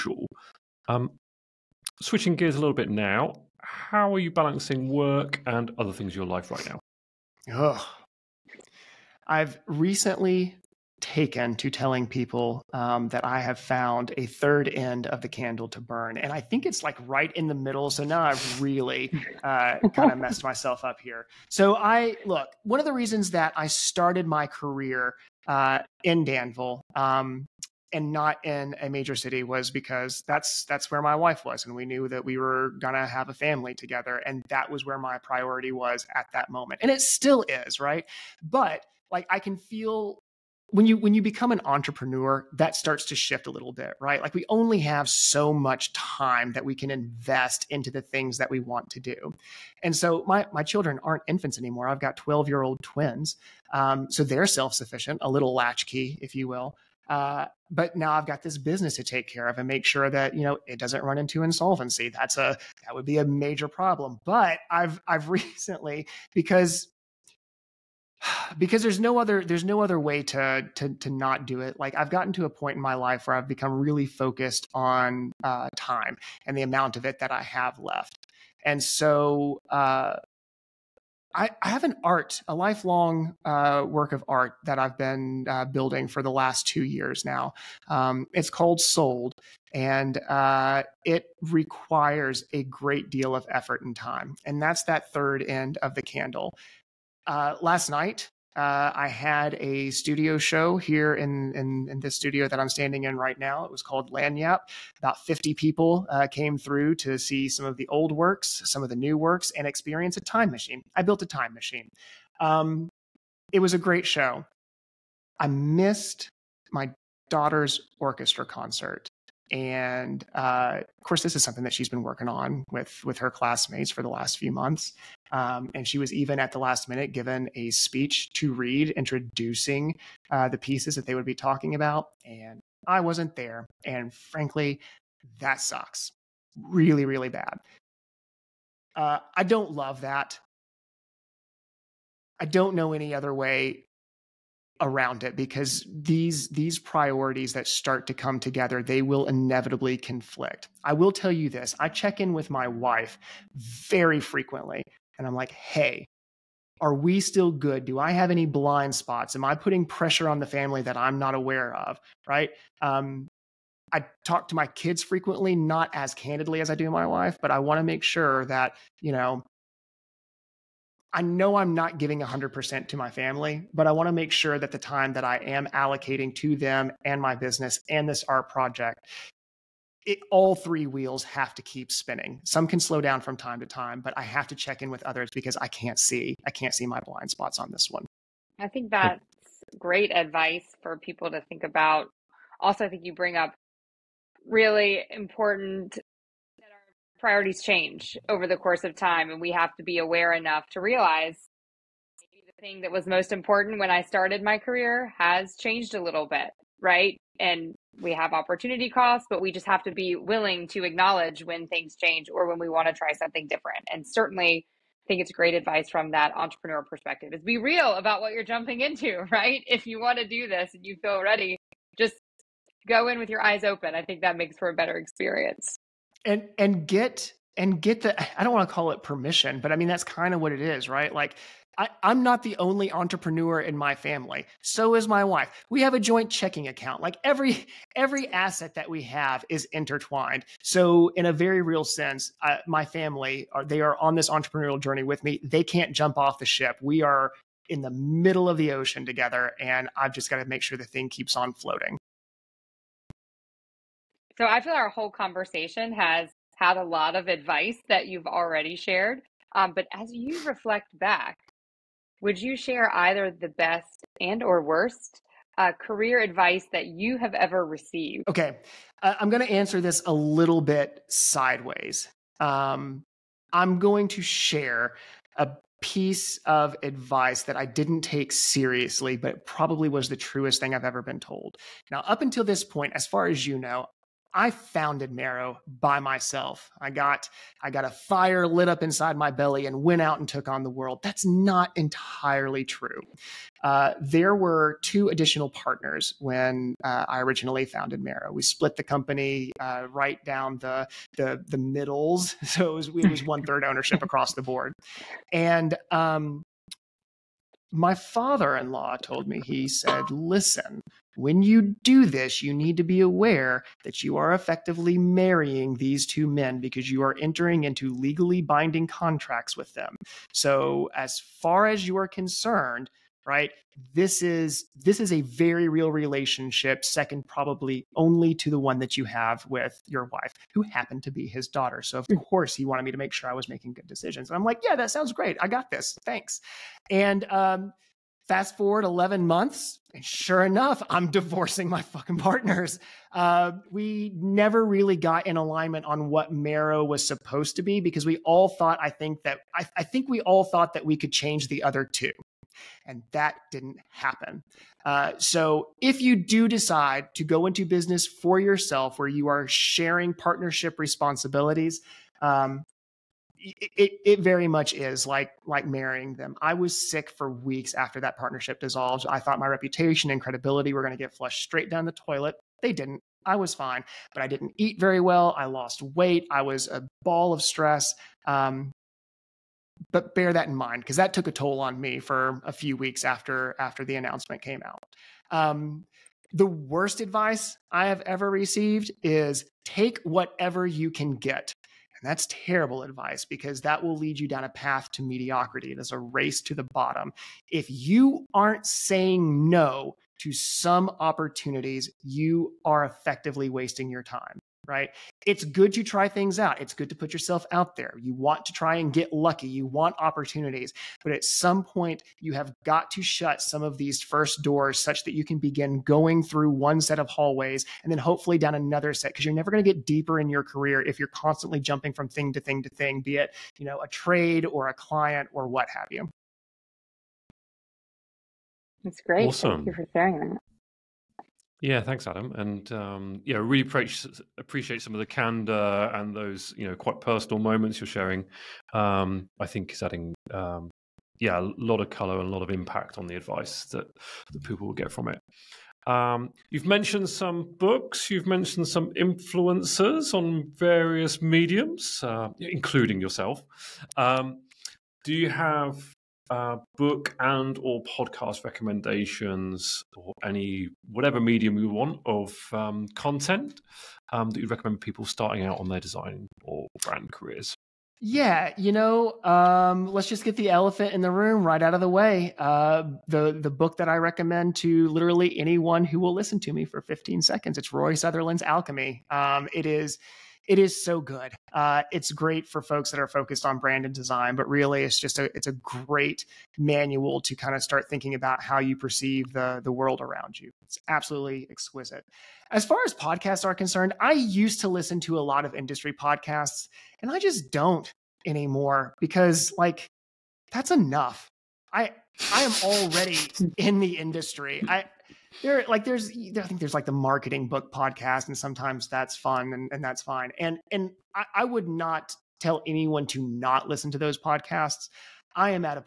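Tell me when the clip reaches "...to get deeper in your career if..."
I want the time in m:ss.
6:59.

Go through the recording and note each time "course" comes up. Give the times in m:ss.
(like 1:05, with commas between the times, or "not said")
2:01, 3:18, 5:32.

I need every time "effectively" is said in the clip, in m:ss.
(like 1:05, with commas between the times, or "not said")
5:14, 6:42.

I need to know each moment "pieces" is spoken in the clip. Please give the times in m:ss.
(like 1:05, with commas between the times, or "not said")
2:10, 4:35.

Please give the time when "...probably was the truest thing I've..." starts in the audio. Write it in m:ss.
4:39.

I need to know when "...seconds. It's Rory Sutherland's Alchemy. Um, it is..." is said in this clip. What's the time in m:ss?
7:57.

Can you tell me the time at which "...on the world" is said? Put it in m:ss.
4:50.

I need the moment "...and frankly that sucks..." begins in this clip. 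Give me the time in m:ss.
2:13.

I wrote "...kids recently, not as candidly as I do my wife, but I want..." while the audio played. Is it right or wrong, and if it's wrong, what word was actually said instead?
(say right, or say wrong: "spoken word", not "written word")
wrong: "frequently", not "recently".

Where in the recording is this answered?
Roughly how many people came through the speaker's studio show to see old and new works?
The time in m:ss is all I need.
1:45.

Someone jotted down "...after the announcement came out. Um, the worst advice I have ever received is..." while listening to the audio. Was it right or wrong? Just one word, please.
right.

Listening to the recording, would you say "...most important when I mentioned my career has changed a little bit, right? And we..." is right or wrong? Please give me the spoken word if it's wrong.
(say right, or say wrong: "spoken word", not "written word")
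wrong: "started", not "mentioned".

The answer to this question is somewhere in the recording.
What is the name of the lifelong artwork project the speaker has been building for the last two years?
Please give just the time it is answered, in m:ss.
1:28.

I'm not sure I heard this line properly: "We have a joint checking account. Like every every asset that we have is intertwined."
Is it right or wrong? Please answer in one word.
right.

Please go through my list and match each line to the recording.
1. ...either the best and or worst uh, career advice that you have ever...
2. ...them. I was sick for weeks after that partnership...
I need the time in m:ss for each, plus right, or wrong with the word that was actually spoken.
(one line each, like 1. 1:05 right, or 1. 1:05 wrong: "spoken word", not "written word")
1. 4:22 right
2. 6:06 right.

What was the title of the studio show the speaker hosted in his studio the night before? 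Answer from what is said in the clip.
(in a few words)
Lagniappe.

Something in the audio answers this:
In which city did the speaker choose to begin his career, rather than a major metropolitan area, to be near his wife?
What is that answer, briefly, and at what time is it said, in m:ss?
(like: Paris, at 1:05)
Danville, at 0:26.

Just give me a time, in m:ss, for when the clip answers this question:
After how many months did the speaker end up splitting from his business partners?
5:38.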